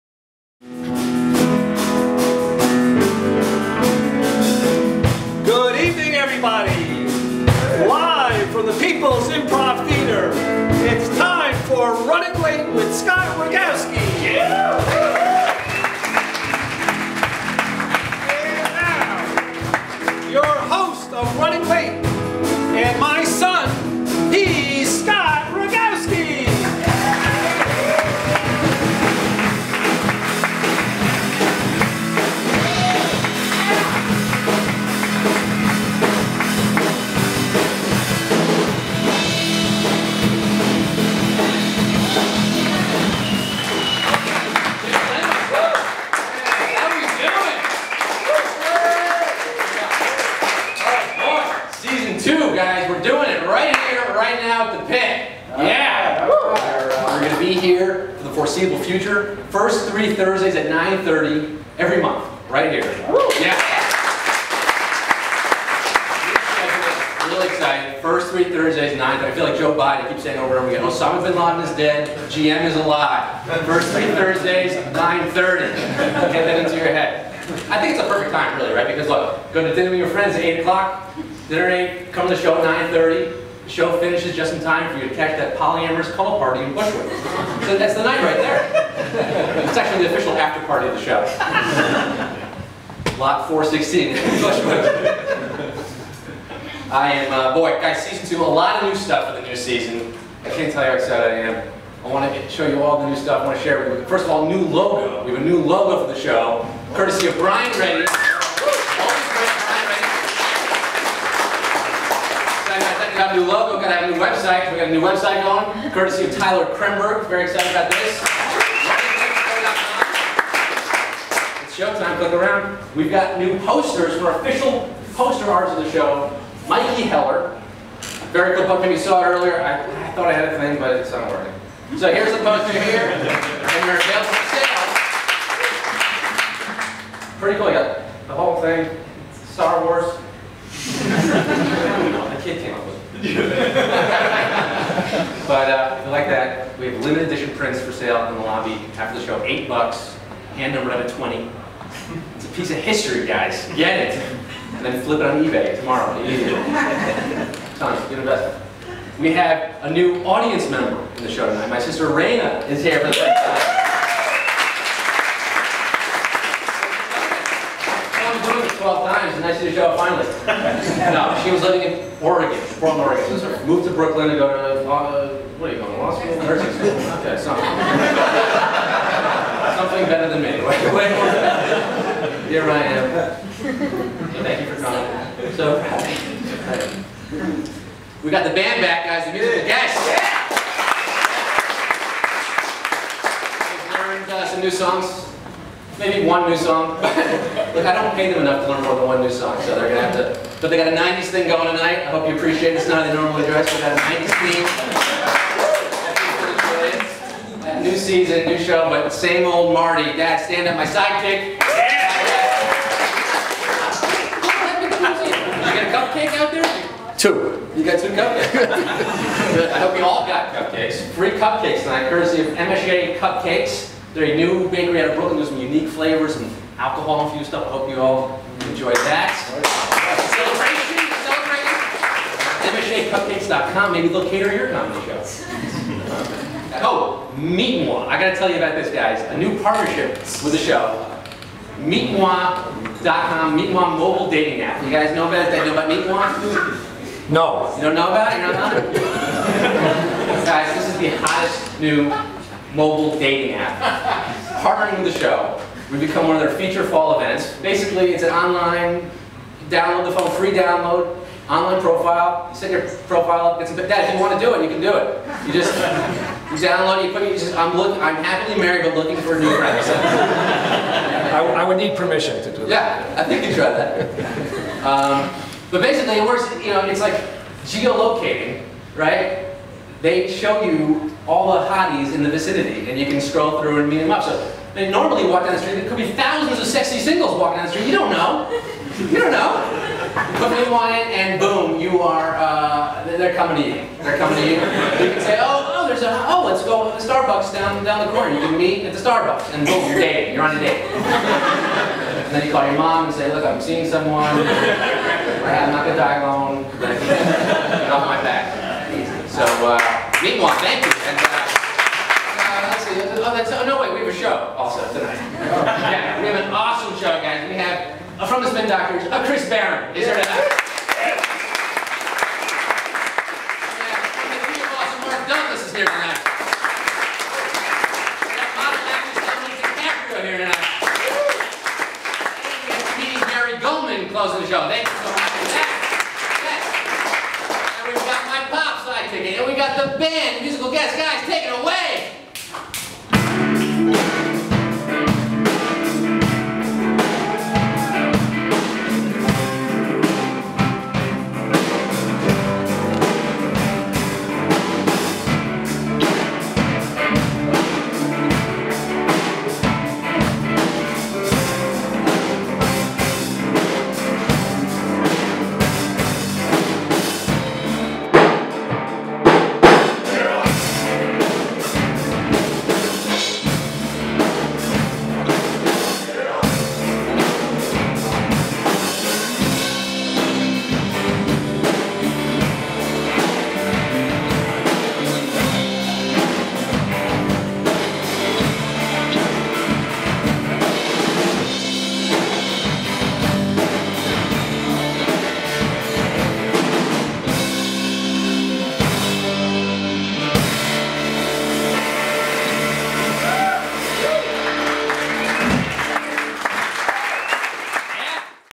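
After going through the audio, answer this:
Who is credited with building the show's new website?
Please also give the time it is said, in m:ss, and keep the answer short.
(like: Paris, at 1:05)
Tyler Kremberg, at 1:56.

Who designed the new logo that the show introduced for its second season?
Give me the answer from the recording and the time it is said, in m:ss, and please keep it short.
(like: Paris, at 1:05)
Brian Reddy, at 1:47.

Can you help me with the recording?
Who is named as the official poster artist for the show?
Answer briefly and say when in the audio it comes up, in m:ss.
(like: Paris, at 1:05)
Mikey Heller, at 2:06.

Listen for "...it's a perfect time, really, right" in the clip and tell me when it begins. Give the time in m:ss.
1:17.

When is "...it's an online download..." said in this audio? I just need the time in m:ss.
4:18.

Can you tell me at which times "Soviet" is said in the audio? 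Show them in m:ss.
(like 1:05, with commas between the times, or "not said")
not said.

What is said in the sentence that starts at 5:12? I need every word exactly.
Oh, that's, oh, no, wait, we have a show also tonight.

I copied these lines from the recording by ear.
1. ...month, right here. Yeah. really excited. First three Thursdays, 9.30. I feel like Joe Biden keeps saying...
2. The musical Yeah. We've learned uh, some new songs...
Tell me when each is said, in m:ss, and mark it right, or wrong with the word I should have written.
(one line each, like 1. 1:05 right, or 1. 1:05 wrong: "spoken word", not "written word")
1. 1:02 right
2. 3:09 right.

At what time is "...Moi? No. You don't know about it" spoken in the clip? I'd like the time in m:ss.
4:06.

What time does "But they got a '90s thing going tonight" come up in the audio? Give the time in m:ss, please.
3:20.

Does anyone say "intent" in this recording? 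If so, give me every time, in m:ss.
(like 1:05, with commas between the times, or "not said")
not said.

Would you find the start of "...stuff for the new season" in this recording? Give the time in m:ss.
1:38.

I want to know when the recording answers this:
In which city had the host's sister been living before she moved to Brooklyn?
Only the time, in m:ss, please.
2:52.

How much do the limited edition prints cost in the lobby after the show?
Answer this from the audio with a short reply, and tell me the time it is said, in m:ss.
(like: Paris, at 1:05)
8 bucks, at 2:29.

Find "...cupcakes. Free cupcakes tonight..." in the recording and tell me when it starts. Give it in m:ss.
3:40.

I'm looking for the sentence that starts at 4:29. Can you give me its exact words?
I, I, would need permission to do that.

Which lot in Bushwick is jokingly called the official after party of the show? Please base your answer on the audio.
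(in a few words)
Lot 416.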